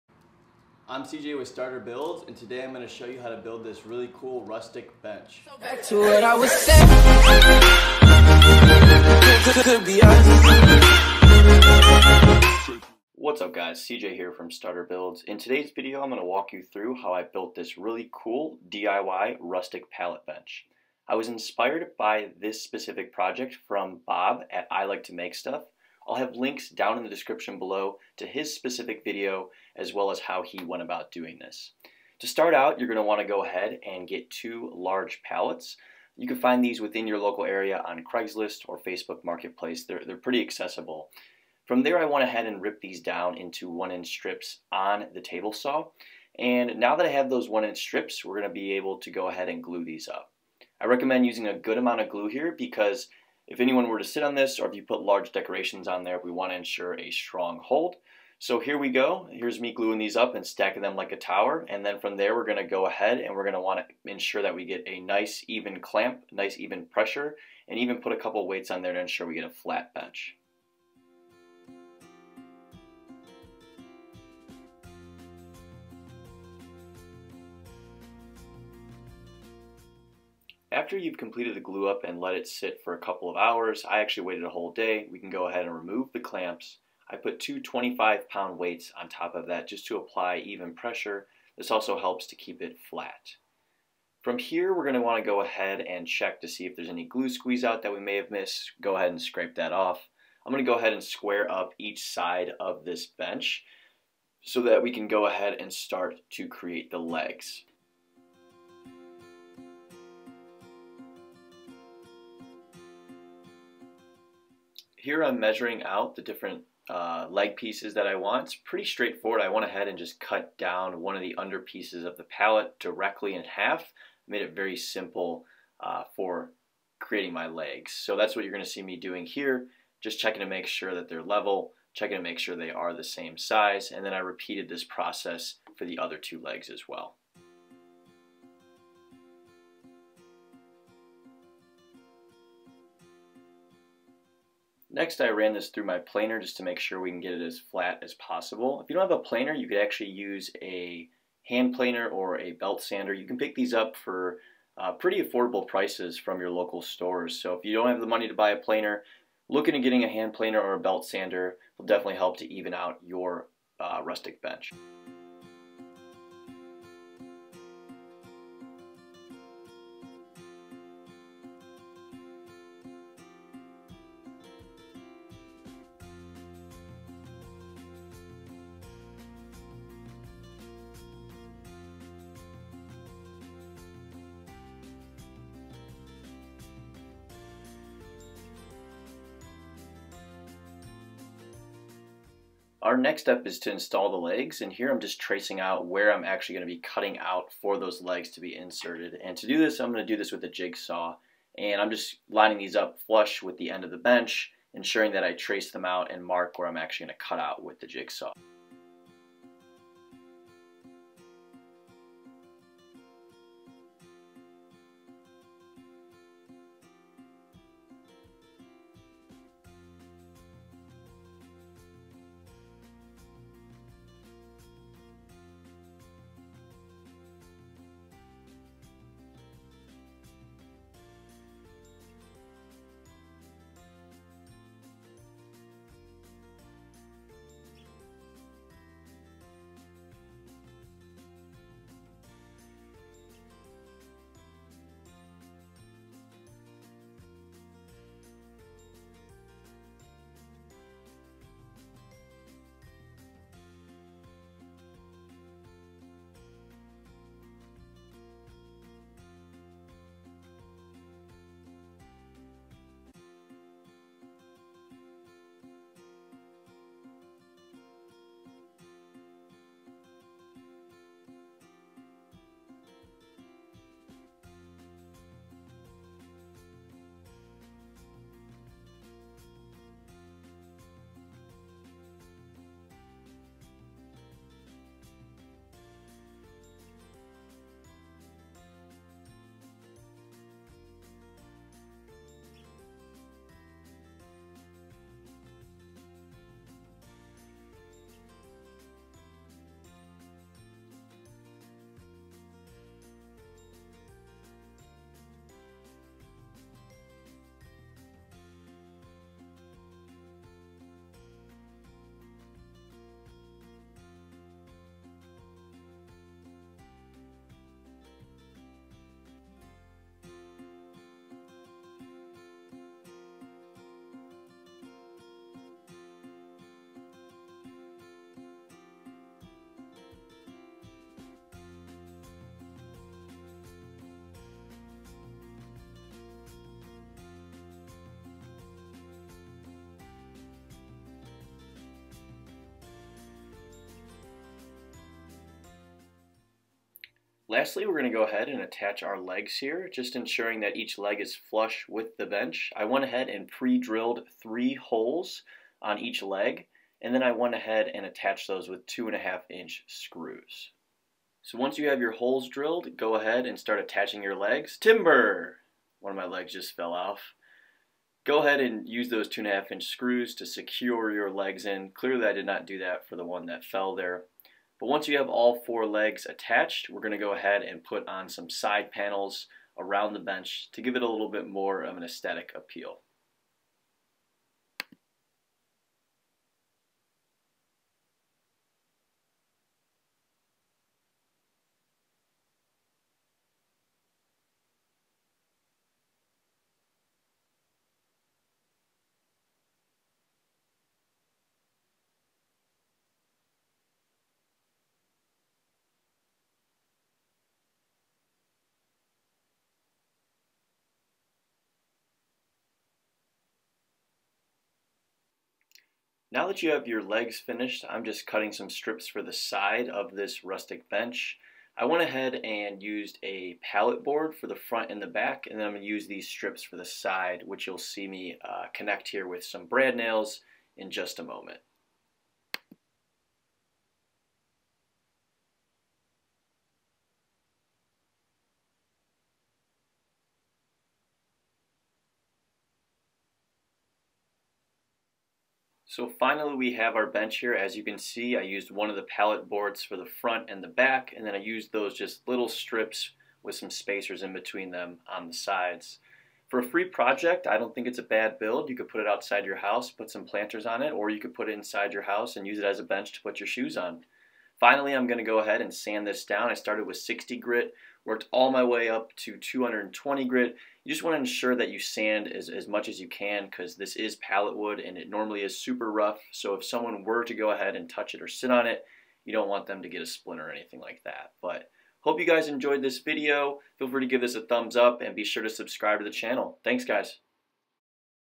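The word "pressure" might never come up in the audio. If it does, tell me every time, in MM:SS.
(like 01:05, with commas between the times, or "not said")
01:06, 01:30.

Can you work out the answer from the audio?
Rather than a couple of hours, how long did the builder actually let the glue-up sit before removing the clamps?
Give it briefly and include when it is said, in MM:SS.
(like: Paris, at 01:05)
A whole day, at 01:24.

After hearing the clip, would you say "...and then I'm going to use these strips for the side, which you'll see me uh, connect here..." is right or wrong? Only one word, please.
right.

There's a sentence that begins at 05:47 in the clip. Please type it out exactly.
Lastly, we're going to go ahead and attach our legs here, just ensuring that each leg is flush with the bench.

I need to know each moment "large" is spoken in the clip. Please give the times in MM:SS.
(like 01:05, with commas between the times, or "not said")
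00:34, 00:55.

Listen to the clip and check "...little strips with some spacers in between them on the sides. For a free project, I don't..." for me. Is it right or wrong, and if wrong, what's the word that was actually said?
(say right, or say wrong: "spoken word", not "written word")
right.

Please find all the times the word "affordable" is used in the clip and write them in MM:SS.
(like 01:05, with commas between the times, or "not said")
02:35.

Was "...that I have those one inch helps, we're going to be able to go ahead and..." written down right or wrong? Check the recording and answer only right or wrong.
wrong.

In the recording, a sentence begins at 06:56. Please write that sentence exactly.
Now that you have your legs finished, I'm just cutting some strips for the side of this rustic bench.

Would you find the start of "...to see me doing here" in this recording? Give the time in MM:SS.
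02:08.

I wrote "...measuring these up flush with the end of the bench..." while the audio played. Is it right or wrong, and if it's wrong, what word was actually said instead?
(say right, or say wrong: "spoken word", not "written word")
wrong: "lining", not "measuring".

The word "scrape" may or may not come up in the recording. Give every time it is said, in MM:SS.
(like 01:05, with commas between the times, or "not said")
01:39.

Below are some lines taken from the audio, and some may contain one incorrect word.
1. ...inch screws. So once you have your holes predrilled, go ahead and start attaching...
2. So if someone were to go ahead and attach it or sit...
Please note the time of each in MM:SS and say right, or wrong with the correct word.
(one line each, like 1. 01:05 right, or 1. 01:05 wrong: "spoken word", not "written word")
1. 05:59 wrong: "drilled", not "predrilled"
2. 07:56 wrong: "touch", not "attach".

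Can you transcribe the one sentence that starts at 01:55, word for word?
here I'm measuring out the different uh, leg pieces that I want.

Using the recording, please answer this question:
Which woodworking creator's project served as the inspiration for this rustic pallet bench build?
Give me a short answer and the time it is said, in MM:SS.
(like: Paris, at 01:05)
Bob at I Like To Make Stuff, at 00:24.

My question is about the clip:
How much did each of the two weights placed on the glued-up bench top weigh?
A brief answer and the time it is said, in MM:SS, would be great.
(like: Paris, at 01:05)
25 pounds, at 01:27.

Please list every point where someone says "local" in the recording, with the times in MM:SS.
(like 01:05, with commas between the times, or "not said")
00:37, 02:36.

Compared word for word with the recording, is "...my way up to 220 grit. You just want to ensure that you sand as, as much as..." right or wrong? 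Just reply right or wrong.
right.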